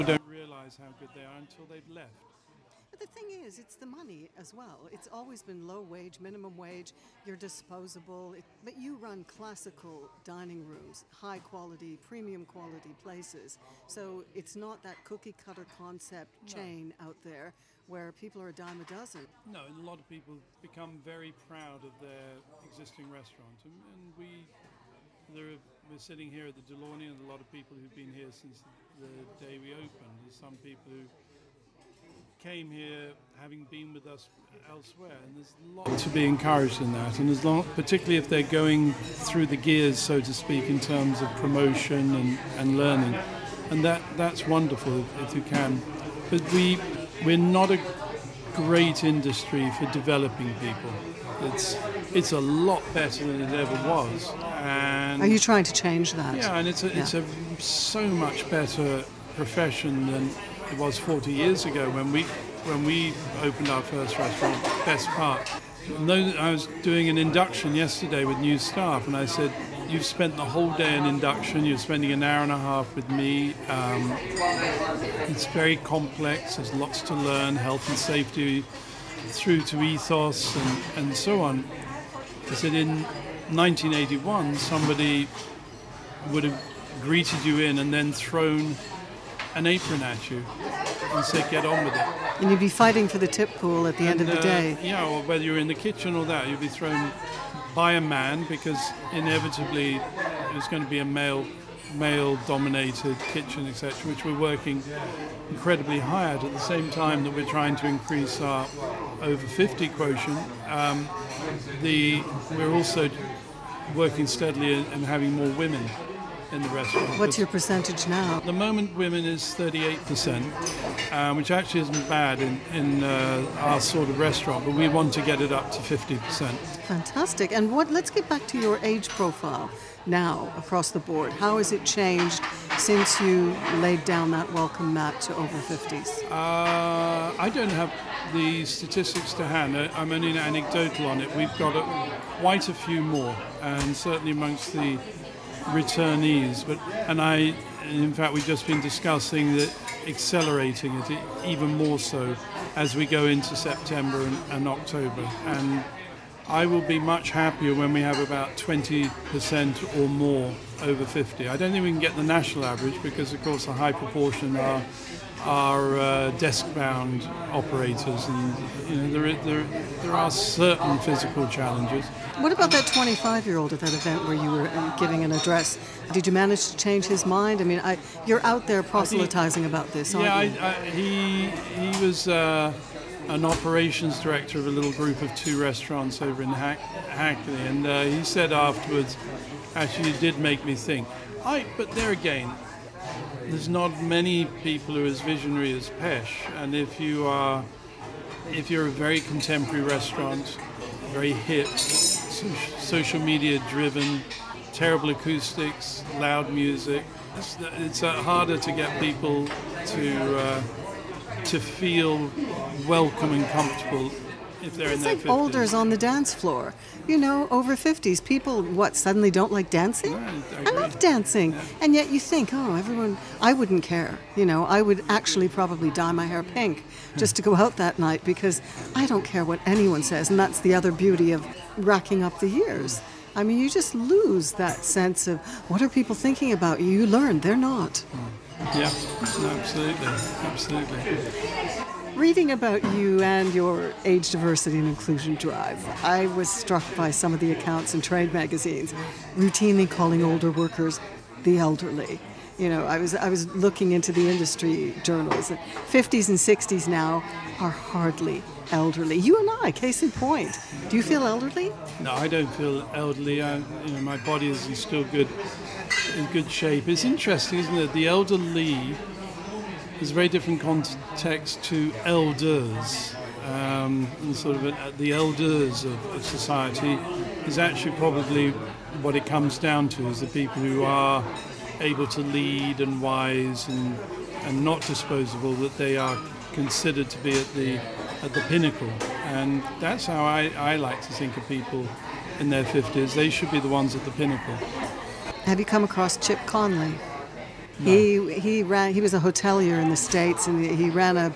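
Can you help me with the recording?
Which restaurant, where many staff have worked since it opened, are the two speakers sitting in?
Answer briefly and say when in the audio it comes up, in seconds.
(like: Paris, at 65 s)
The Delaunay, at 26 s.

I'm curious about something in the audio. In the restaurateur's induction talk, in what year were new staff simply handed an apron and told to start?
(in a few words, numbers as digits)
1981.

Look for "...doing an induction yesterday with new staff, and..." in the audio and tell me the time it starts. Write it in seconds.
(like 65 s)
66 s.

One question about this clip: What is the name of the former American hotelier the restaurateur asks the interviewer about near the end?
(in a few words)
Chip Conley.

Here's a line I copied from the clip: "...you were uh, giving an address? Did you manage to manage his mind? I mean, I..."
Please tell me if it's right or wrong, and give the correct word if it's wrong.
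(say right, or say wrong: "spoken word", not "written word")
wrong: "change", not "manage".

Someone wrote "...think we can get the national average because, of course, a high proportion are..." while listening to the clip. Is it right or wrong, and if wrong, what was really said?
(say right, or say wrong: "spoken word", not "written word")
right.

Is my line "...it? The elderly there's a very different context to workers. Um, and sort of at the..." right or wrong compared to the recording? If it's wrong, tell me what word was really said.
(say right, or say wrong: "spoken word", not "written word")
wrong: "elders", not "workers".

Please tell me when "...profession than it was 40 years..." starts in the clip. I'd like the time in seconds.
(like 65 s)
59 s.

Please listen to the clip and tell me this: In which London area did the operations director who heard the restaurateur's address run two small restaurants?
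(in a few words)
Hackney.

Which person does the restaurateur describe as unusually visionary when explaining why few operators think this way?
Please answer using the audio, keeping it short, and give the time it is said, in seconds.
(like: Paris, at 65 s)
Pesh, at 196 s.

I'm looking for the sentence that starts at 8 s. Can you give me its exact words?
It, but you run classical dining rooms, high quality, premium quality places.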